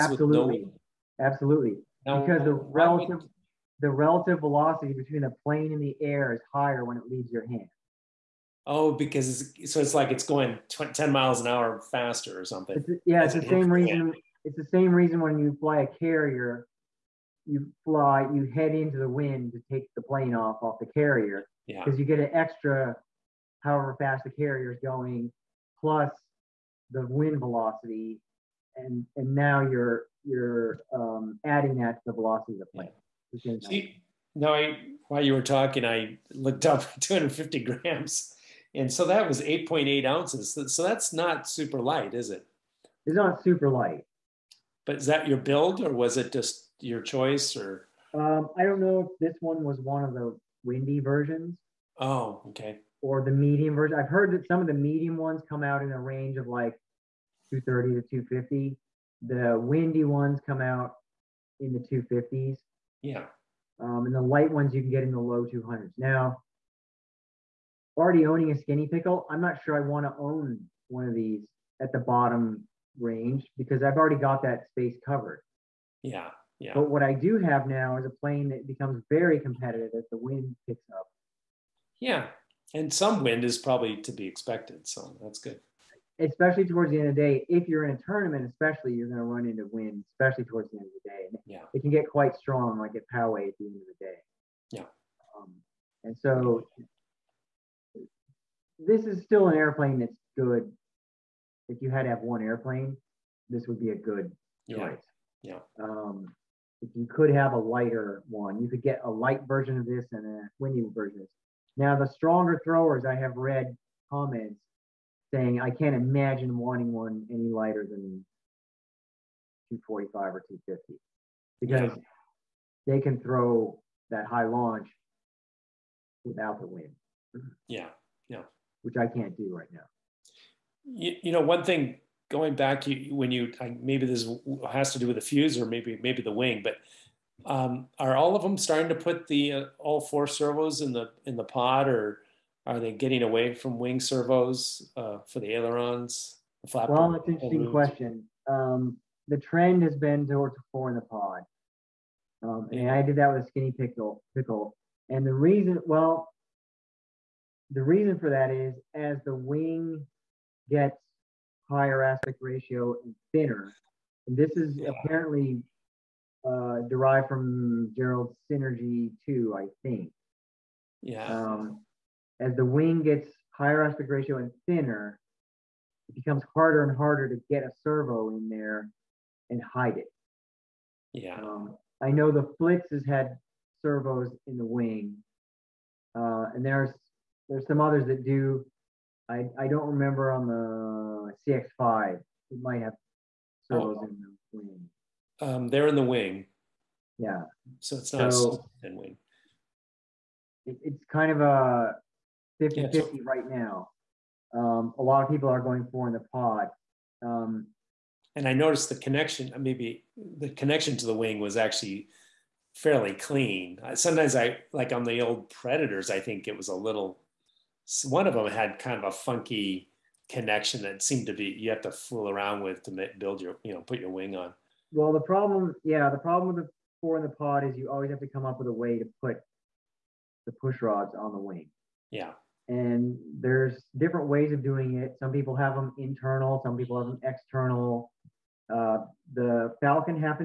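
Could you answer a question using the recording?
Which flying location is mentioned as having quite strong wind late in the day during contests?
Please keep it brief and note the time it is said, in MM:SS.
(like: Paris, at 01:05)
Poway, at 01:33.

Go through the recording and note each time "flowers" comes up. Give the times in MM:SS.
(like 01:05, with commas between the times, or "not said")
not said.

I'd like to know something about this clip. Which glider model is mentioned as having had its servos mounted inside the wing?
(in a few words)
Flitz.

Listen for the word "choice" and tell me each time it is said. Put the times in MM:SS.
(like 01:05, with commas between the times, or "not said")
00:47, 01:44.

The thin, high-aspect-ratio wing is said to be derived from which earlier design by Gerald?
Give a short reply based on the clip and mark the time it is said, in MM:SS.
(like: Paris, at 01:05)
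Synergy 2, at 02:48.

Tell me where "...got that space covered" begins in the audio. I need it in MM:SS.
01:14.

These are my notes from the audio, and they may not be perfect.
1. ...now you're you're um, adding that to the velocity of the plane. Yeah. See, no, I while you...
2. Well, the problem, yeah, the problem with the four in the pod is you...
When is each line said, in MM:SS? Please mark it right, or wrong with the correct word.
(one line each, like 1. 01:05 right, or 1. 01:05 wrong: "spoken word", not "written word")
1. 00:29 right
2. 03:44 right.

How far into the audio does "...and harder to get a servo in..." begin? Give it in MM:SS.
02:56.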